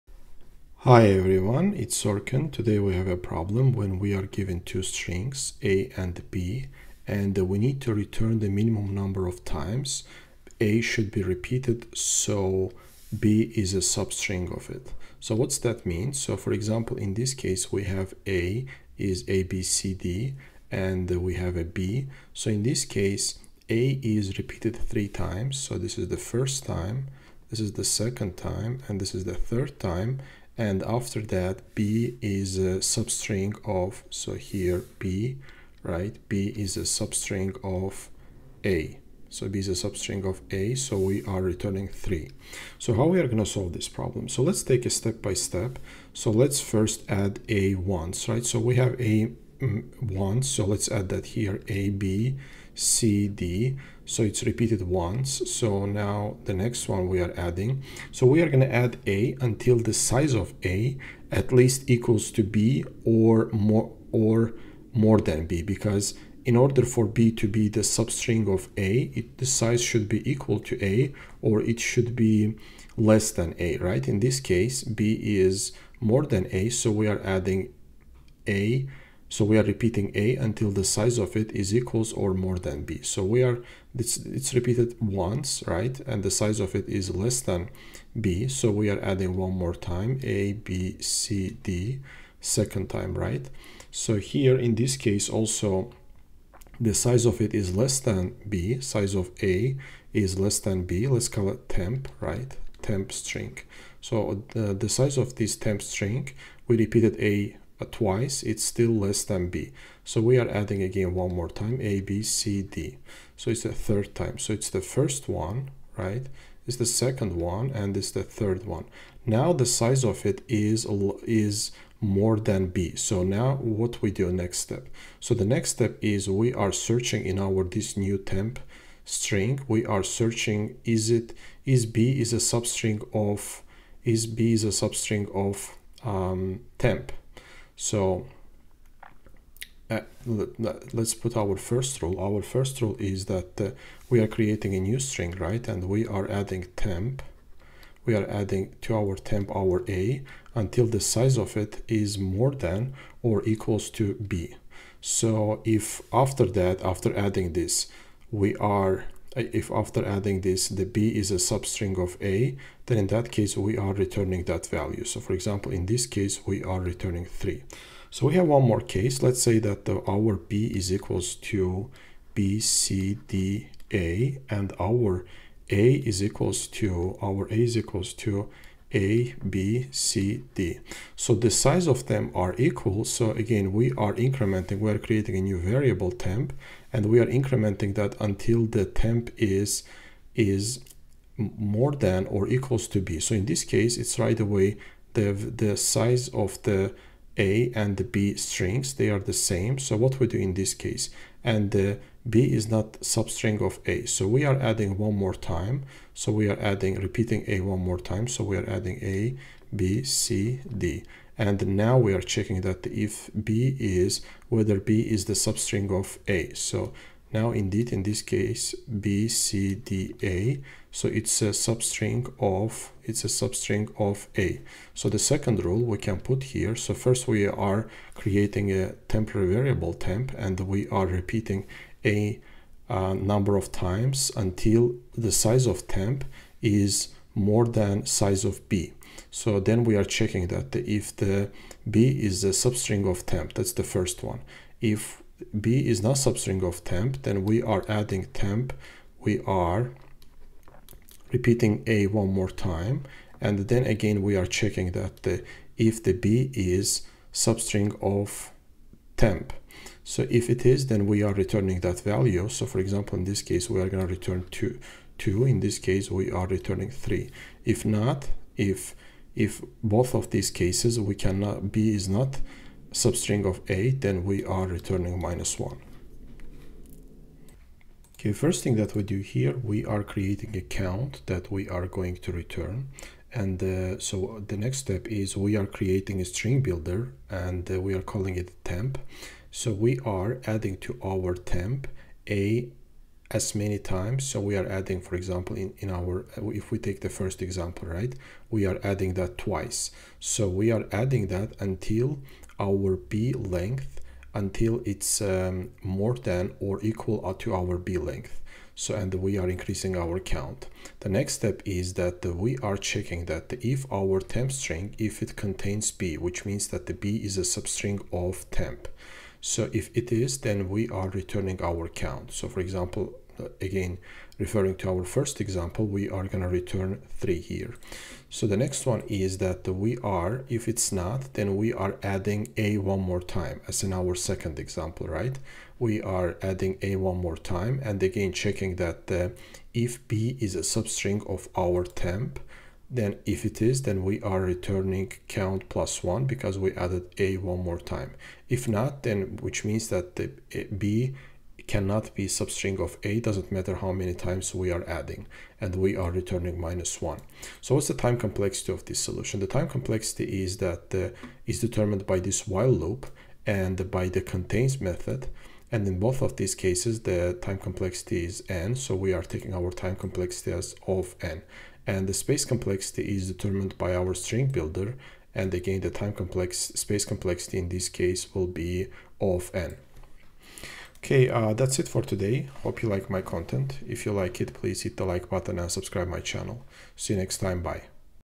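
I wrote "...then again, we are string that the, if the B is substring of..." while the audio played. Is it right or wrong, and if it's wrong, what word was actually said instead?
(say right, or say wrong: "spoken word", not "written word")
wrong: "checking", not "string".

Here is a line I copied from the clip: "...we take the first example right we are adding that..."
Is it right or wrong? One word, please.
right.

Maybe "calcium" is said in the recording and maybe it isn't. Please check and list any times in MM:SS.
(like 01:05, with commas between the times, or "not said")
not said.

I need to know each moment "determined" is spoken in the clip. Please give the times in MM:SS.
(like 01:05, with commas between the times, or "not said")
06:01, 06:13.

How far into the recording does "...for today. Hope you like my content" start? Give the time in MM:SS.
06:21.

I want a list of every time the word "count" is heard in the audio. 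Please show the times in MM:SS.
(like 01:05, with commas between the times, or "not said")
04:40, 05:10, 05:21, 05:45.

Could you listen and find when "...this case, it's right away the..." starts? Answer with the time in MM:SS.
03:13.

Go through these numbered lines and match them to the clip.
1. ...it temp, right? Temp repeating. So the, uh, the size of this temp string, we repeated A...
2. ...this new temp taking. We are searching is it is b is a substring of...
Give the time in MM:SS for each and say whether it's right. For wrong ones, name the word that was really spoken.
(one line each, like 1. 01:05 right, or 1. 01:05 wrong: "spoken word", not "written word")
1. 01:41 wrong: "string", not "repeating"
2. 02:07 wrong: "string", not "taking".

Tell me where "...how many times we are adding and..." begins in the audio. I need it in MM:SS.
05:53.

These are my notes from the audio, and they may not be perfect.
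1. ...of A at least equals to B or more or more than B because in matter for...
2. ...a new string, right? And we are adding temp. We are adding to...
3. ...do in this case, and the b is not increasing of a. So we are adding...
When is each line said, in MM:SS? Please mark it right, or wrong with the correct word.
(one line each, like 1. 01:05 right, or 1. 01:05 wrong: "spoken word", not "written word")
1. 01:00 wrong: "order", not "matter"
2. 02:24 right
3. 03:20 wrong: "substring", not "increasing".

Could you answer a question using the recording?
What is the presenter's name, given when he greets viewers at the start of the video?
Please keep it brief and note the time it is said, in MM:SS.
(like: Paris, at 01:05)
Orkhan, at 00:02.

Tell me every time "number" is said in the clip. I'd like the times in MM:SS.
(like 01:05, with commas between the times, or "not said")
00:08, 03:53.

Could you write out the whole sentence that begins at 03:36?
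So now indeed, in this case, B, C, D, A.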